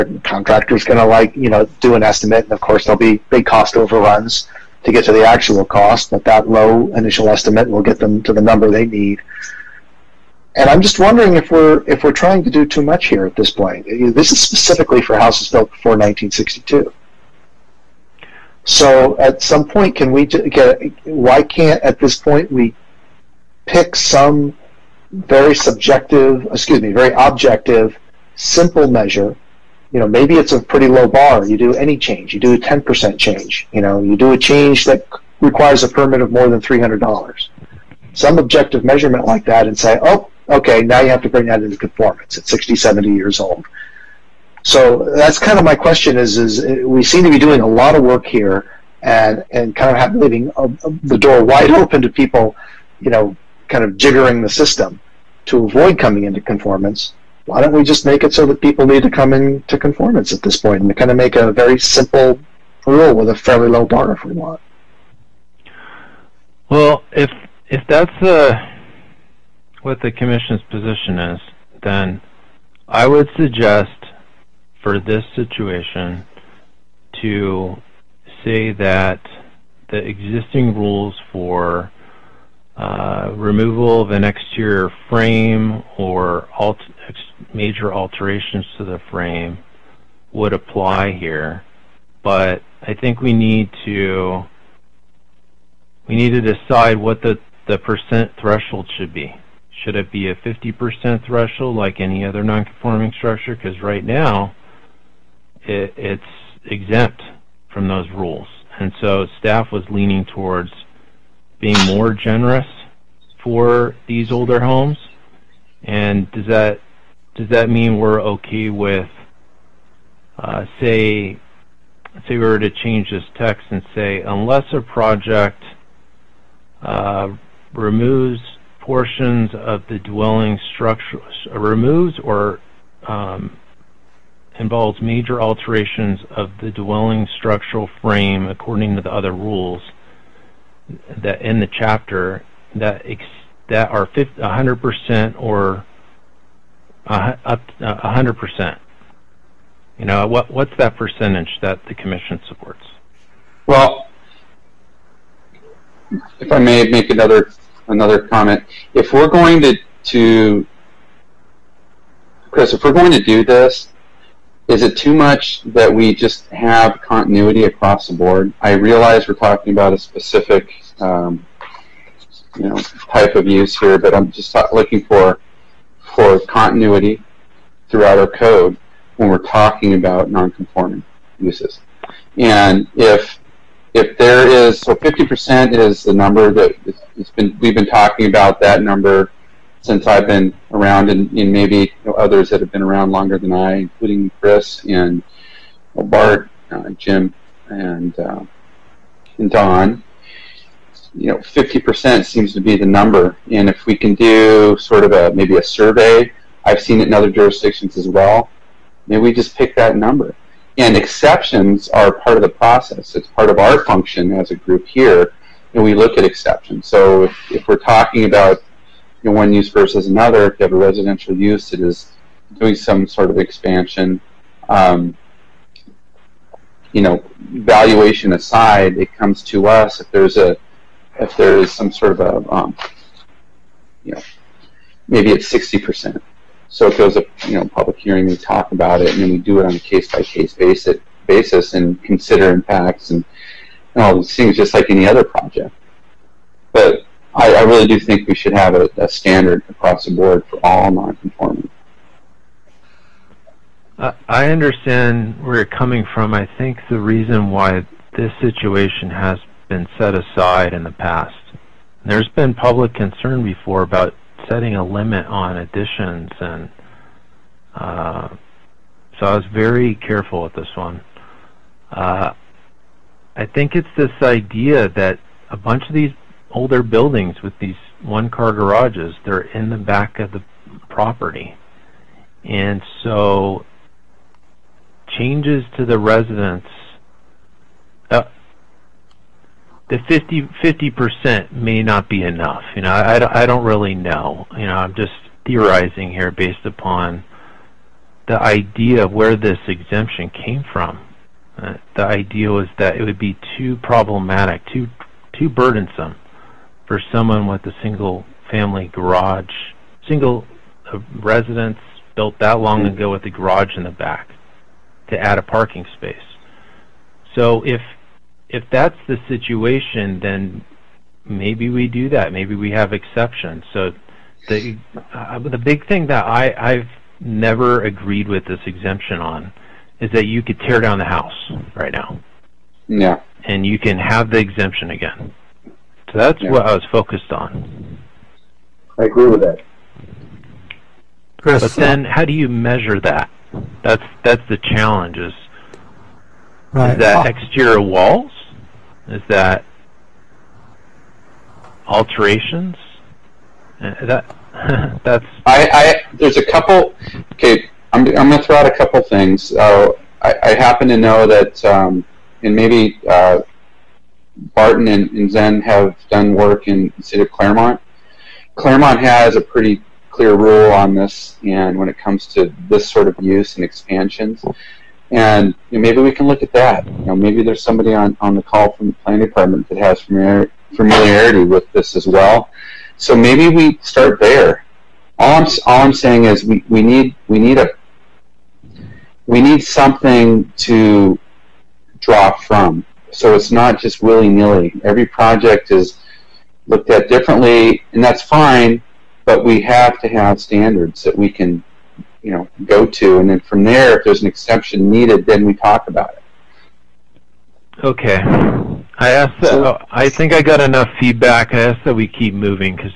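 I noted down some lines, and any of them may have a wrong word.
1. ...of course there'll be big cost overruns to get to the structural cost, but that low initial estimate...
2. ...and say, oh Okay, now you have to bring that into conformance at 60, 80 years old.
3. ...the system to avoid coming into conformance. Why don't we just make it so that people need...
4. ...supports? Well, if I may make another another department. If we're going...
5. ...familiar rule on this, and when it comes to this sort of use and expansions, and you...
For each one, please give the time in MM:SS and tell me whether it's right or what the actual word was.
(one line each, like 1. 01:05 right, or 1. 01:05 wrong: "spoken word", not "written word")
1. 00:02 wrong: "actual", not "structural"
2. 00:39 wrong: "70", not "80"
3. 00:54 right
4. 02:32 wrong: "comment", not "department"
5. 06:10 wrong: "clear", not "familiar".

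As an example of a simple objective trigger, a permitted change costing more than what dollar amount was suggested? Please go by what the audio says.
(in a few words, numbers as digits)
$300.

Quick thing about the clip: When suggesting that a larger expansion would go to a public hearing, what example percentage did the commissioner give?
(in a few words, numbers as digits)
60%.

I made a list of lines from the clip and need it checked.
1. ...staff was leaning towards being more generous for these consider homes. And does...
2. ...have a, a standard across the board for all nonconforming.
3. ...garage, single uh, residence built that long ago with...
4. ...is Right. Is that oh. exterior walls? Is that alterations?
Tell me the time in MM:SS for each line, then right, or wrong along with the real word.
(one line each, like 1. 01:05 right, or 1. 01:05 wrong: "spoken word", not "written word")
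1. 01:49 wrong: "older", not "consider"
2. 04:08 right
3. 05:08 right
4. 05:45 right.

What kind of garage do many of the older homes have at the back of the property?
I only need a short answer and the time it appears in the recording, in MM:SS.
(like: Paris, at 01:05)
one-car garages, at 04:38.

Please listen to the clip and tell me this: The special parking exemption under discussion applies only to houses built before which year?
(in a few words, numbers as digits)
1962.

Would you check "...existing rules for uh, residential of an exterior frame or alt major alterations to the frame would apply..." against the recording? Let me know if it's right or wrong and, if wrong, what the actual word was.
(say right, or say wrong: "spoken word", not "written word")
wrong: "removal", not "residential".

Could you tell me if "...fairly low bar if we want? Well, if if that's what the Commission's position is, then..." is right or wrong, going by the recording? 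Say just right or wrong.
right.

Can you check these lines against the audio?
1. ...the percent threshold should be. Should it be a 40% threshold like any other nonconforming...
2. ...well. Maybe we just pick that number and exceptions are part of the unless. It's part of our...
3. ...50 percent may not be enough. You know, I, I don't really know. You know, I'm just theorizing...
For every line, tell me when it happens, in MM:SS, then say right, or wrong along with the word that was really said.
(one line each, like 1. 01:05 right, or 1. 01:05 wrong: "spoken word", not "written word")
1. 01:37 wrong: "50", not "40"
2. 03:28 wrong: "process", not "unless"
3. 04:50 right.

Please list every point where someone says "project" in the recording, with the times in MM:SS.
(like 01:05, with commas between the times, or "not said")
02:04, 04:05, 06:35.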